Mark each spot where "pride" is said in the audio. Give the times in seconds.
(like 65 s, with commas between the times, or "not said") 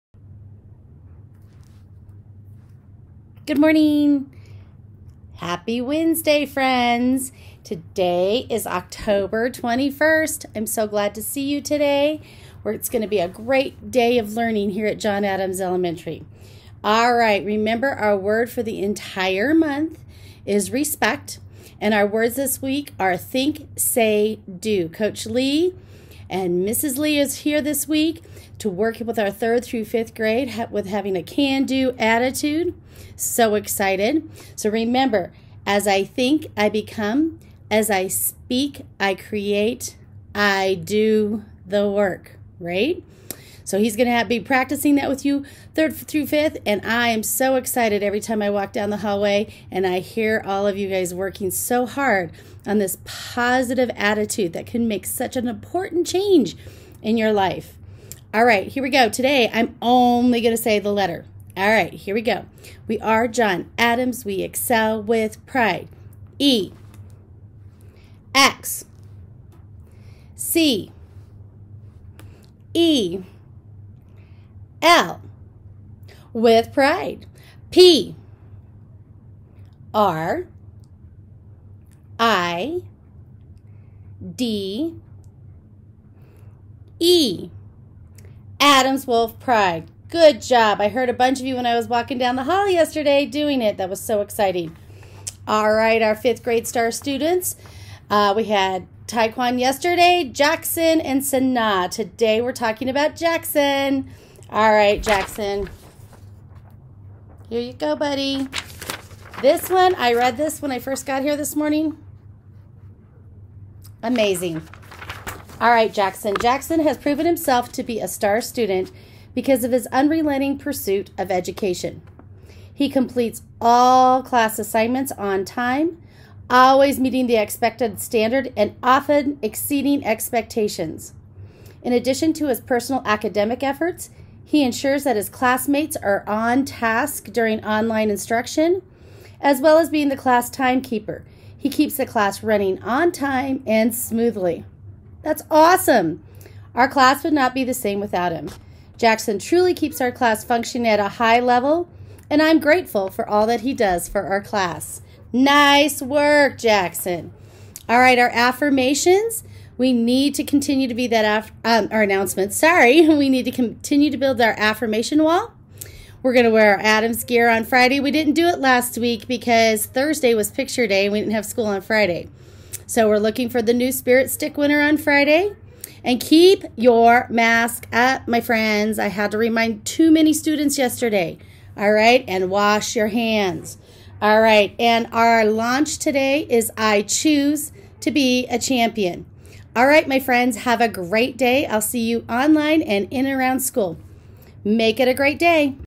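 65 s, 76 s, 89 s.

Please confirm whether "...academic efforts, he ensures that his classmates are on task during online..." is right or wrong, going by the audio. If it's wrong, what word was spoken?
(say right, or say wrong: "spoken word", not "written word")
right.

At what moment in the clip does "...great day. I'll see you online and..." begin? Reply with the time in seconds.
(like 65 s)
190 s.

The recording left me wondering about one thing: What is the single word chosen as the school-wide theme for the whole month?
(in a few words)
Respect.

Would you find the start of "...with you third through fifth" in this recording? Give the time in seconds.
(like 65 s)
45 s.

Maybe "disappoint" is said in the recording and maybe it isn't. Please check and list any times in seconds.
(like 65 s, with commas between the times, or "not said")
not said.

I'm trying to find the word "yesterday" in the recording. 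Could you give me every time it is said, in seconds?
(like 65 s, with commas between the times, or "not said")
92 s, 99 s, 180 s.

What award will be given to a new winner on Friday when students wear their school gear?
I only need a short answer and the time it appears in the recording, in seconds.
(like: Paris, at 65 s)
Spirit Stick, at 173 s.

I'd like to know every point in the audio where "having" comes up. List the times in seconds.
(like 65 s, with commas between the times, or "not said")
30 s.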